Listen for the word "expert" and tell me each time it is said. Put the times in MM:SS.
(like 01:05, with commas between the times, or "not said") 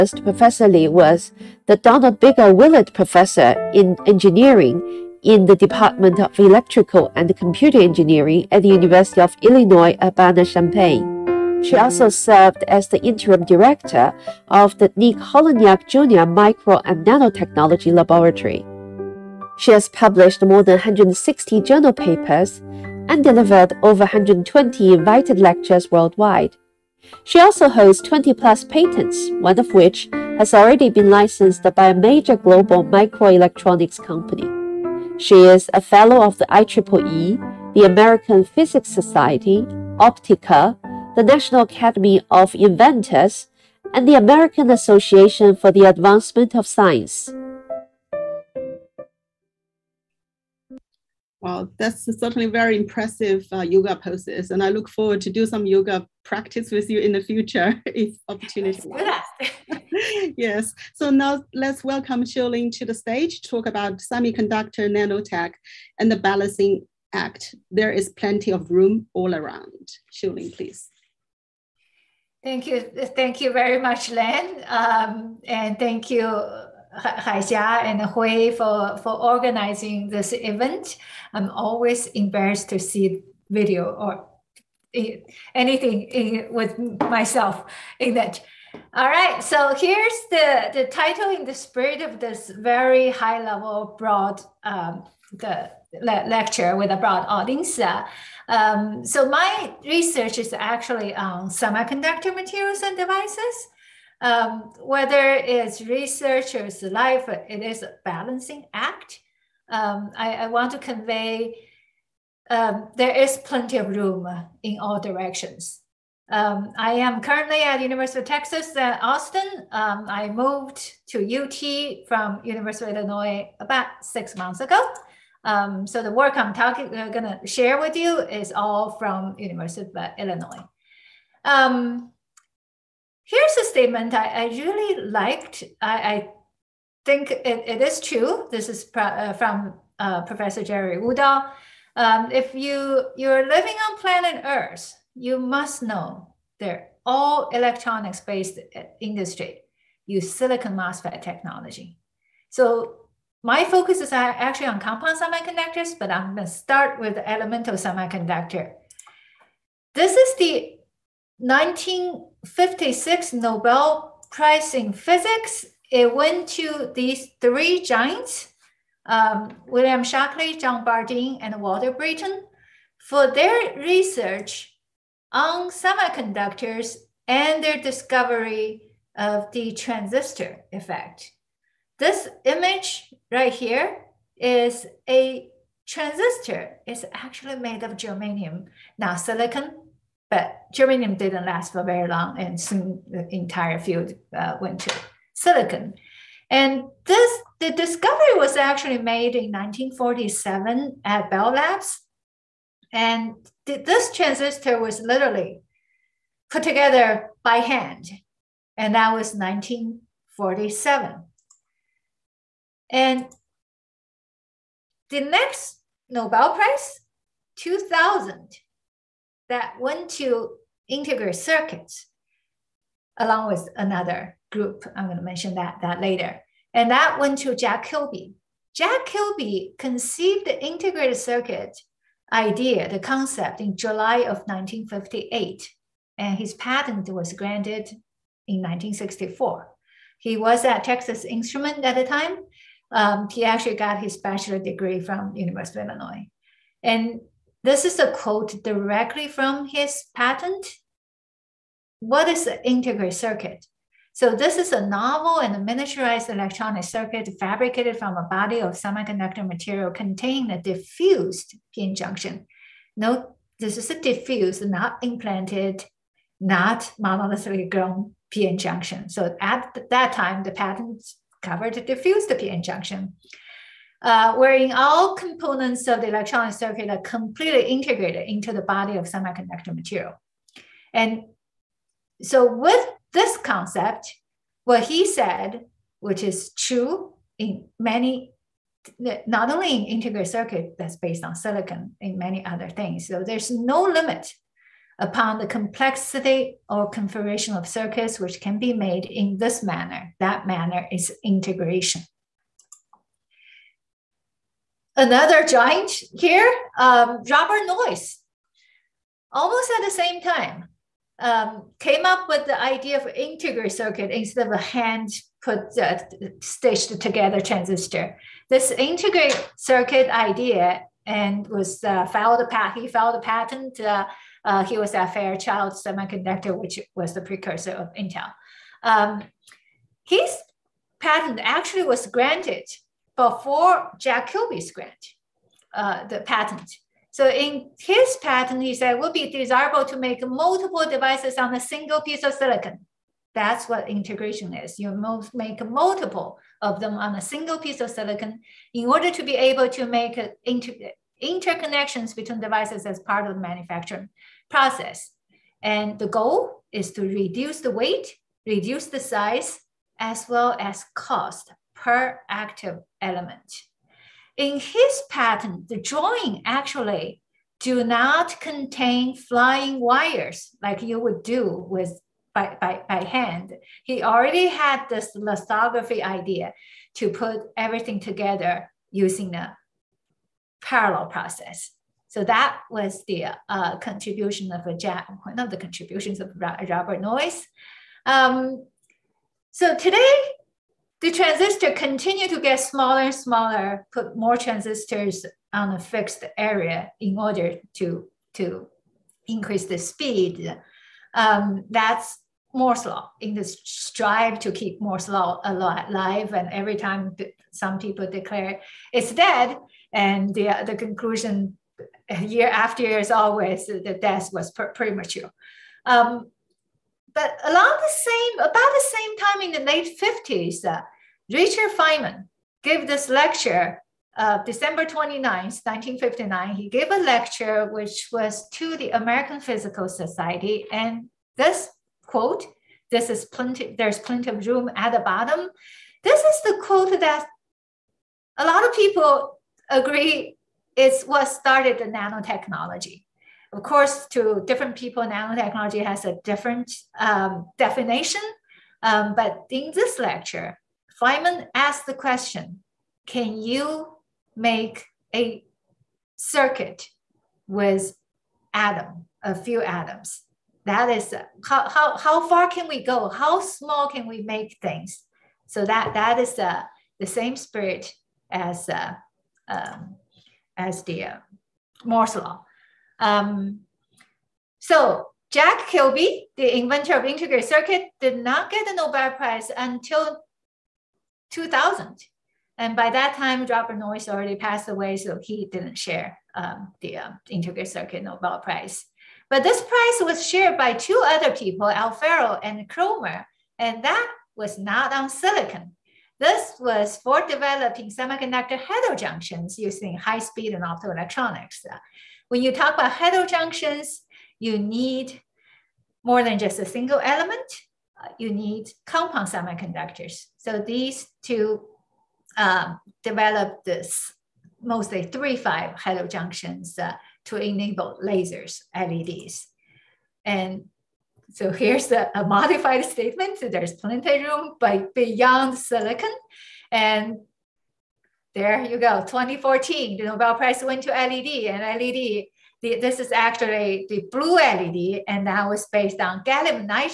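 not said.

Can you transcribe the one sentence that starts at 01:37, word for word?
Uh, um, so my research is actually on semiconductor materials and devices um, whether it's researchers' life, it is a balancing act.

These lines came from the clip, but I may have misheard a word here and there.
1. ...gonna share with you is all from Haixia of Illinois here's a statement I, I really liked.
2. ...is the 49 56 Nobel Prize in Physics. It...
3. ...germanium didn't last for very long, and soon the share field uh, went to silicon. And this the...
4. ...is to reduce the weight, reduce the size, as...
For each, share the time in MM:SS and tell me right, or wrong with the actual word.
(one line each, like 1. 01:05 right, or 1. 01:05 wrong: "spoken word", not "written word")
1. 02:07 wrong: "University", not "Haixia"
2. 02:40 wrong: "19", not "49"
3. 03:10 wrong: "entire", not "share"
4. 05:56 right.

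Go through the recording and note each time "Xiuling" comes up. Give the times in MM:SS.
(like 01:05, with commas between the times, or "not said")
01:02, 01:10.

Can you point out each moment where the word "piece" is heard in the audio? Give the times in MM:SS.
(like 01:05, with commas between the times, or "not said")
05:41, 05:47.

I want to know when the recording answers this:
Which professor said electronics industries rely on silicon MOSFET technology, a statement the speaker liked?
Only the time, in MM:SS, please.
02:20.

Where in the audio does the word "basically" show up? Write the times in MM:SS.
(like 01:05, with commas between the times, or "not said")
not said.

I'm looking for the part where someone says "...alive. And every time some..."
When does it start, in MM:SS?
06:45.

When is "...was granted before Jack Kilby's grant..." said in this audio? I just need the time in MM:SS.
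05:31.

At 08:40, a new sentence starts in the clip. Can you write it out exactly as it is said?
And so here's a, a modified statement.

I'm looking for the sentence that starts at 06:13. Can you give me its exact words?
He already had this lithography idea to put everything together using a parallel process.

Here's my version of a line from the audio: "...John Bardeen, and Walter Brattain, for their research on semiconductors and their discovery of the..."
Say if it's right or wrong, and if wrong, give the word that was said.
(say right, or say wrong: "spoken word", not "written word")
right.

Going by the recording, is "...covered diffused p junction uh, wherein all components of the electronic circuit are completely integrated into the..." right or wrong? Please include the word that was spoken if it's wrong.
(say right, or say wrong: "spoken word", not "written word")
right.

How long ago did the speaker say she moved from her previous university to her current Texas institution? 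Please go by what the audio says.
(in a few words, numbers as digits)
about six months.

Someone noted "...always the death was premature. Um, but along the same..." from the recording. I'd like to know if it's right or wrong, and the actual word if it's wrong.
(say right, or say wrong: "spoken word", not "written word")
right.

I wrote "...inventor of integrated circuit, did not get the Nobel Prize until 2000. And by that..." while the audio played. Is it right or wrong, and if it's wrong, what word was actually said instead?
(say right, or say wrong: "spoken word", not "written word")
right.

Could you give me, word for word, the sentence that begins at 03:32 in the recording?
And the next Nobel Prize, 2000, that went to integrate circuits along with another group.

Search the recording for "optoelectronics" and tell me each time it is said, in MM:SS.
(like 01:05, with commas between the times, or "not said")
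08:20.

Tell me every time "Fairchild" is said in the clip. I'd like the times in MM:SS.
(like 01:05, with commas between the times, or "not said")
05:25.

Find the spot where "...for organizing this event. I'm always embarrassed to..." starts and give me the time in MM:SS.
01:19.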